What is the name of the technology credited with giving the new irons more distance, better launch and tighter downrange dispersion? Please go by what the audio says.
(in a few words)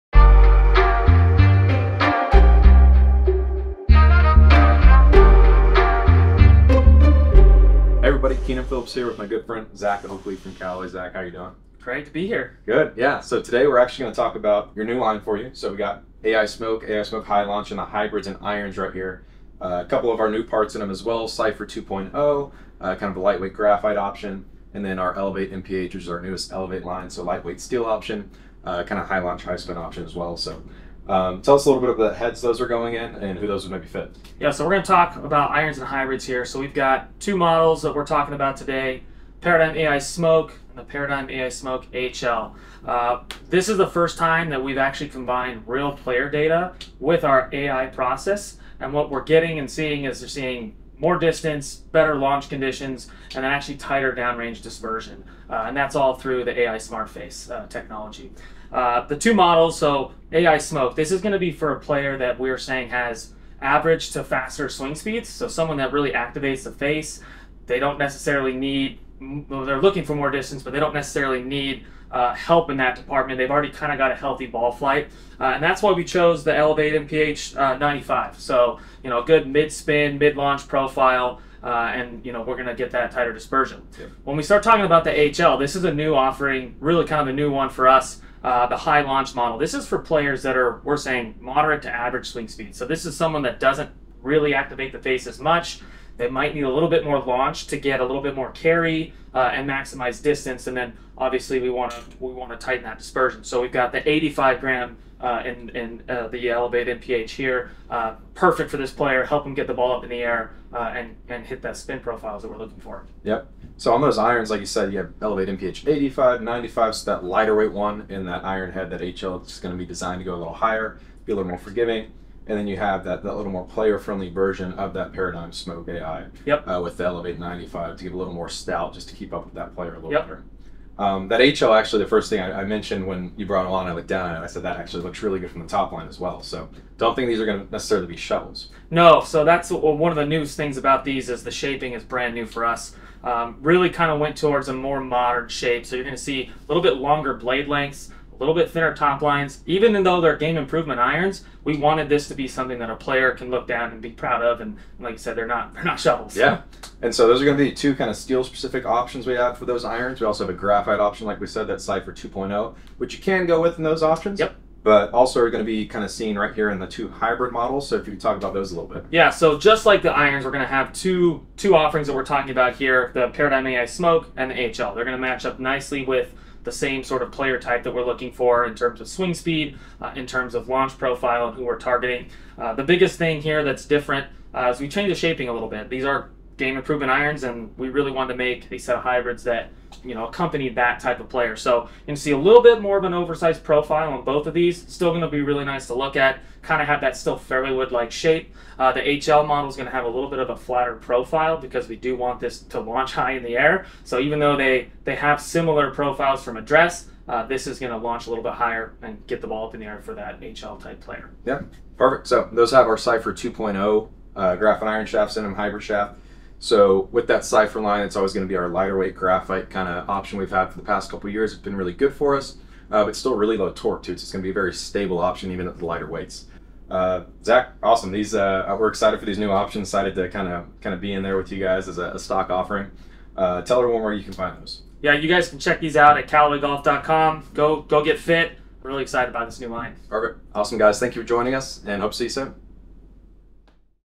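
AI Smart Face.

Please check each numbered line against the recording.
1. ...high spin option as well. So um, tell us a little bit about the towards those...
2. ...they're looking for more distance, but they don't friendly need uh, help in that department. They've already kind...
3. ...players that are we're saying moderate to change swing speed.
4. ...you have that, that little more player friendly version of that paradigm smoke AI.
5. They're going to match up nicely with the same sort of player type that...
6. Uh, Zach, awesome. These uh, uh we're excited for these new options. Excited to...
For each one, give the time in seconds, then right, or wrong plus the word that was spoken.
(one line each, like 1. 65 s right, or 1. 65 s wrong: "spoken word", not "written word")
1. 29 s wrong: "heads", not "towards"
2. 69 s wrong: "necessarily", not "friendly"
3. 89 s wrong: "average", not "change"
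4. 122 s right
5. 174 s right
6. 226 s right.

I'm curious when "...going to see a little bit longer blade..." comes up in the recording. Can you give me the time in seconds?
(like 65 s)
146 s.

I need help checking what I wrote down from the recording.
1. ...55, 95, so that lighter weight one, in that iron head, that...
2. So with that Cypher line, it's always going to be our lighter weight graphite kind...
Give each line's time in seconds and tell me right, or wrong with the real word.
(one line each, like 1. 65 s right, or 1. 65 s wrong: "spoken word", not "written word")
1. 115 s wrong: "85", not "55"
2. 216 s right.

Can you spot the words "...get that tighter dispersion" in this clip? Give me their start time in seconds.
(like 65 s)
82 s.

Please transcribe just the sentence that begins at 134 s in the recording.
I said that actually looks really good from the top line as well.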